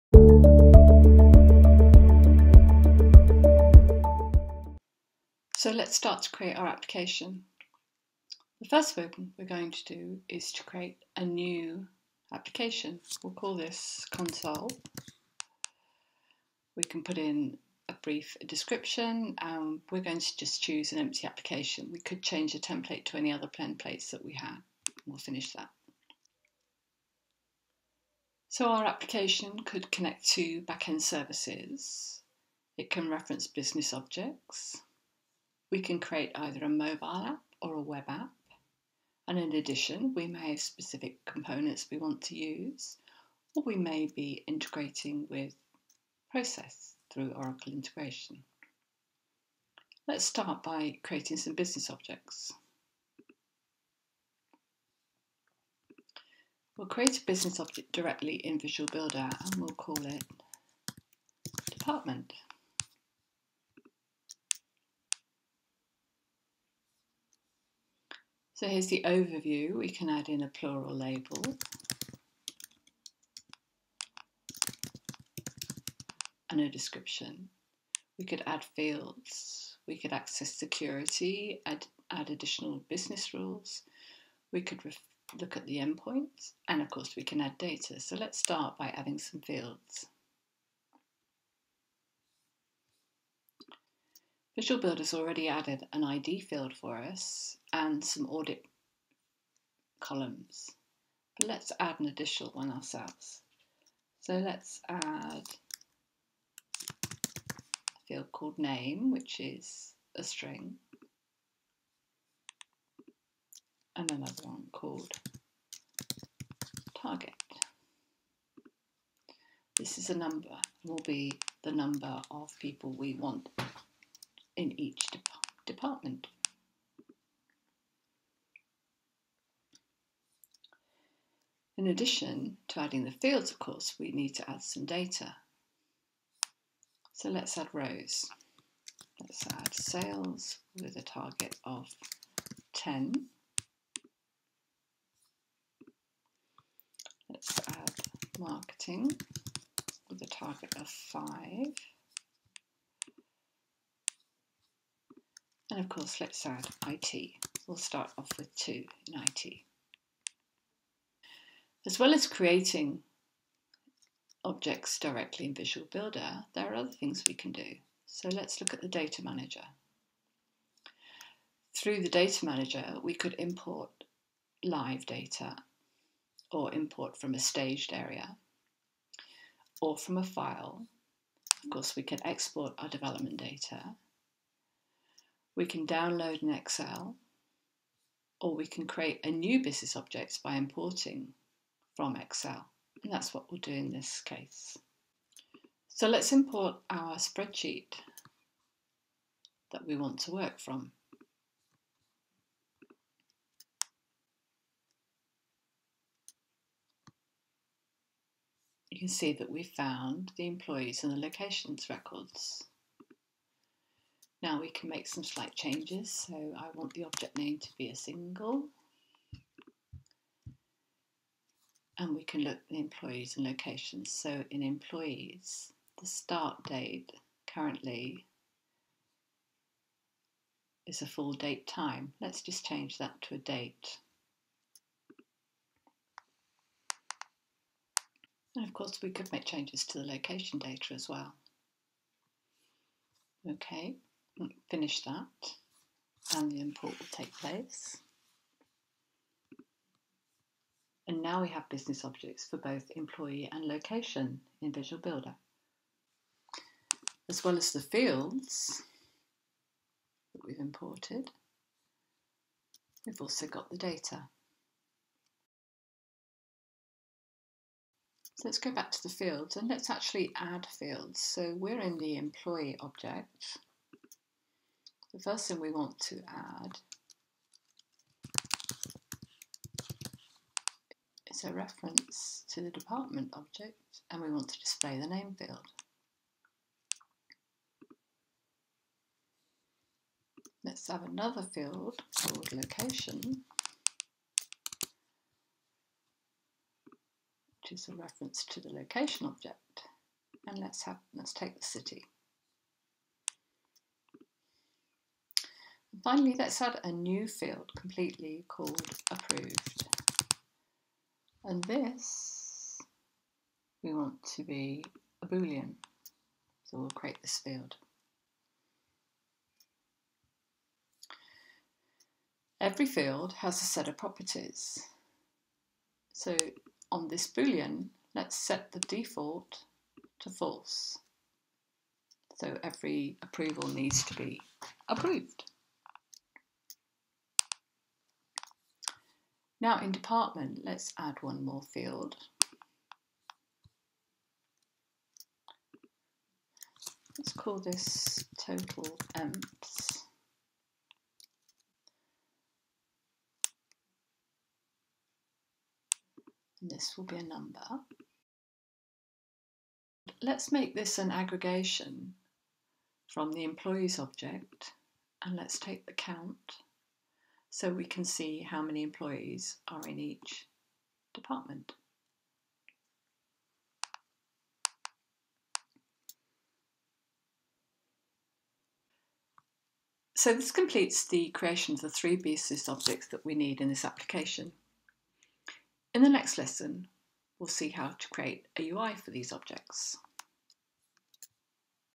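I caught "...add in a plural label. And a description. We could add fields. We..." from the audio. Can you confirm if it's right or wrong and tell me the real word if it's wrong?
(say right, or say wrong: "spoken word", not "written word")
right.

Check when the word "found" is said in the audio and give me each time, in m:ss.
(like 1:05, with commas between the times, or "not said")
3:29.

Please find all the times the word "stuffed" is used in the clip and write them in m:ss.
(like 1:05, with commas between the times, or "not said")
not said.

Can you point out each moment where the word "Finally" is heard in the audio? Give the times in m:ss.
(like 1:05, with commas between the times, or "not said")
5:06.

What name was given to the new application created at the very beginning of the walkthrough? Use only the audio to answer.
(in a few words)
console.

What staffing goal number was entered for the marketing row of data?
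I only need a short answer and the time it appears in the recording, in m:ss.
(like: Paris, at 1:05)
5, at 2:30.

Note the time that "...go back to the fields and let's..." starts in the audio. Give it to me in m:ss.
4:28.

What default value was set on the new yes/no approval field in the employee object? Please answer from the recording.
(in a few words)
false.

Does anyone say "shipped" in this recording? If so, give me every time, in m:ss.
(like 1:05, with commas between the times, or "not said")
not said.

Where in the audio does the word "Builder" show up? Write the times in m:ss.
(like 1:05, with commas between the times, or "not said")
0:58, 1:34, 2:45, 4:15.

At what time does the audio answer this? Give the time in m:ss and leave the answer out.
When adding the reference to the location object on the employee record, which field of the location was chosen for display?
5:01.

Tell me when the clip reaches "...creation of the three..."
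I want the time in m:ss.
6:21.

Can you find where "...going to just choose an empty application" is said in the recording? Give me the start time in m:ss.
0:20.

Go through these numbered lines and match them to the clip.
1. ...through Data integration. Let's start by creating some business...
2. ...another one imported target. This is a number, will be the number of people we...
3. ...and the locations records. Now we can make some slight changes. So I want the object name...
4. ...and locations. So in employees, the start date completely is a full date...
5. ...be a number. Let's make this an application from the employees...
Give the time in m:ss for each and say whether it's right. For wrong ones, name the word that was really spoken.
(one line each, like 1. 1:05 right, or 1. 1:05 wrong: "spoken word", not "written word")
1. 0:47 wrong: "Oracle", not "Data"
2. 1:54 wrong: "called", not "imported"
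3. 3:31 right
4. 3:43 wrong: "currently", not "completely"
5. 5:57 wrong: "aggregation", not "application".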